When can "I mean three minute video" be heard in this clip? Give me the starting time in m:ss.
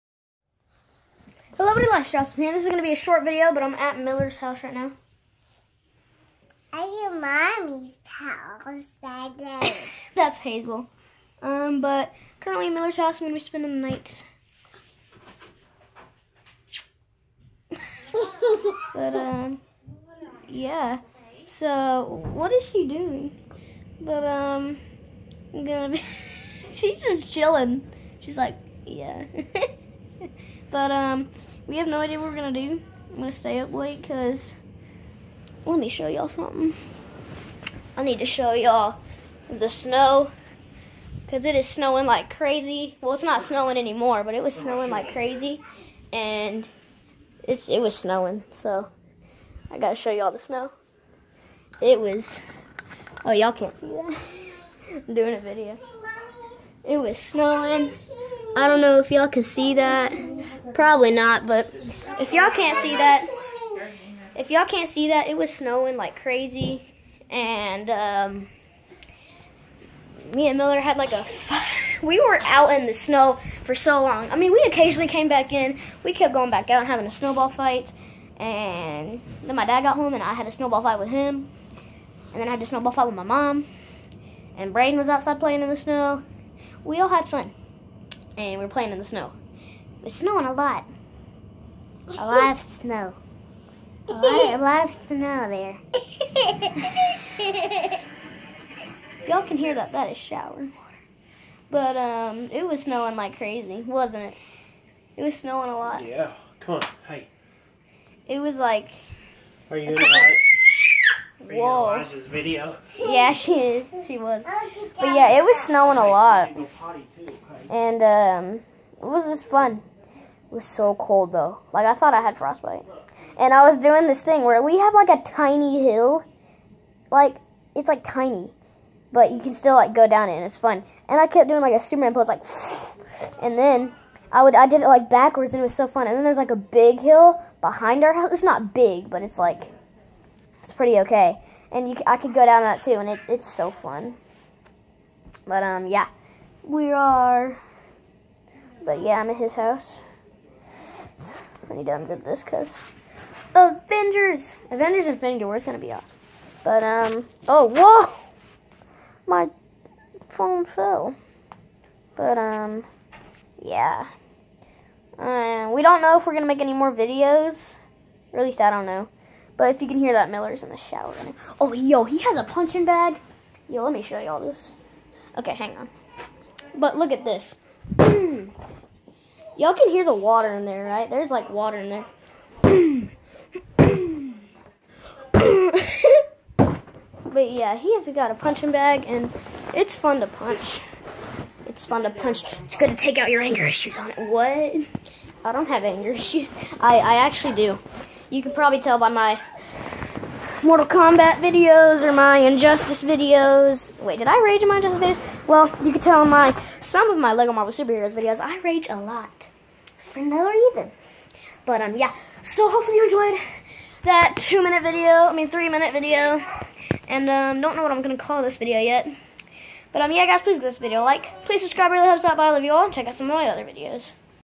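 3:35.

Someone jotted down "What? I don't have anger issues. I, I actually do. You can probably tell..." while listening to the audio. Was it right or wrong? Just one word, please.
right.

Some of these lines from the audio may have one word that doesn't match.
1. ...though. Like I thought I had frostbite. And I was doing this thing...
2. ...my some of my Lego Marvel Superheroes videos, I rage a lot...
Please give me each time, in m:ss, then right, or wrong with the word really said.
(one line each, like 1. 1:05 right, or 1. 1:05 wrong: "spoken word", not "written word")
1. 2:01 right
2. 3:26 right.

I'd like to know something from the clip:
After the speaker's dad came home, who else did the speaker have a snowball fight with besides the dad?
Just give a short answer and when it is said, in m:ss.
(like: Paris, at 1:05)
mom, at 1:23.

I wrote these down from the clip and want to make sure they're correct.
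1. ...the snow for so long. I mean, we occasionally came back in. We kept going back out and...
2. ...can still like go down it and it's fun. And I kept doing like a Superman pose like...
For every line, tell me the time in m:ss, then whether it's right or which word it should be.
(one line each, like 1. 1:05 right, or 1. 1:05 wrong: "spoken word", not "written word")
1. 1:12 right
2. 2:09 right.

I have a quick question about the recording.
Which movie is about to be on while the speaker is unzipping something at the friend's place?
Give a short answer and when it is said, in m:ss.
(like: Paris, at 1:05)
Avengers Infinity War, at 2:34.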